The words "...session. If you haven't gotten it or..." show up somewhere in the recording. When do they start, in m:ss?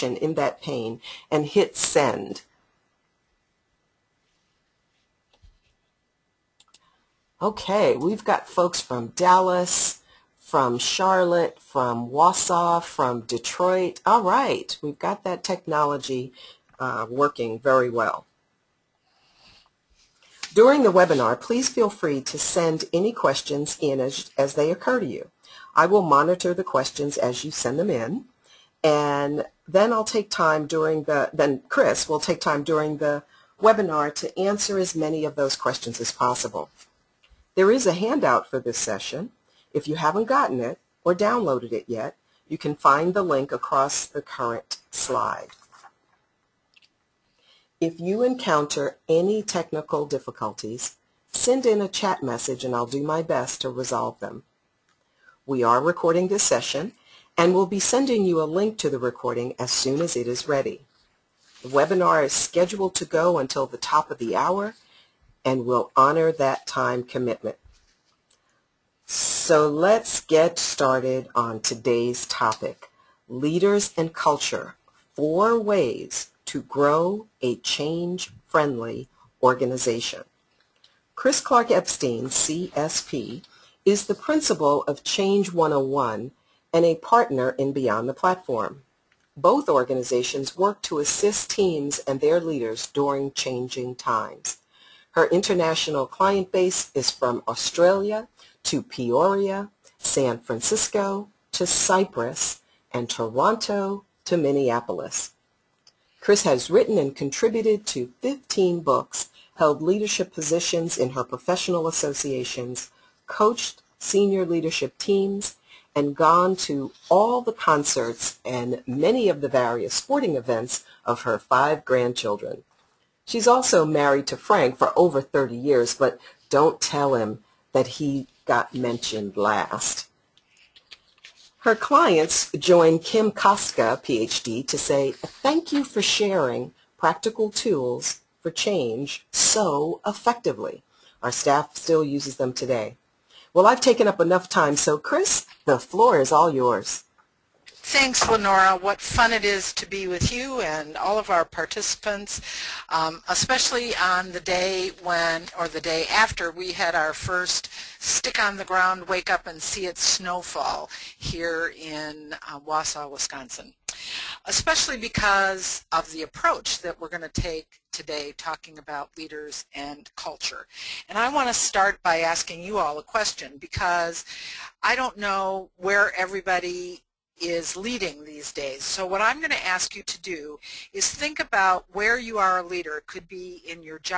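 0:38.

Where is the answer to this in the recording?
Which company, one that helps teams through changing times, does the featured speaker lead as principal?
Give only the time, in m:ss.
1:25.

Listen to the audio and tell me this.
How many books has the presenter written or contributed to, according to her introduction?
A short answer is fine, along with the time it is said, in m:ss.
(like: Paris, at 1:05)
15, at 1:48.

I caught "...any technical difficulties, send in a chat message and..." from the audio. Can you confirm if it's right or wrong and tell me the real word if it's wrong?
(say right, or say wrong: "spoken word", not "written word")
right.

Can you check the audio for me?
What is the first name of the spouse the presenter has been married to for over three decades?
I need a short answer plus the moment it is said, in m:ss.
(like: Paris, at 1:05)
Frank, at 2:04.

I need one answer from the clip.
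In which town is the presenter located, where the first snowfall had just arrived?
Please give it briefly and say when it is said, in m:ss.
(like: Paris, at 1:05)
Wausau, Wisconsin, at 2:42.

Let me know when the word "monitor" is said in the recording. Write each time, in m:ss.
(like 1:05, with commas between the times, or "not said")
0:26.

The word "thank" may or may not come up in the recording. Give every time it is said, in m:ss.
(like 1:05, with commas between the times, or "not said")
2:15, 2:27.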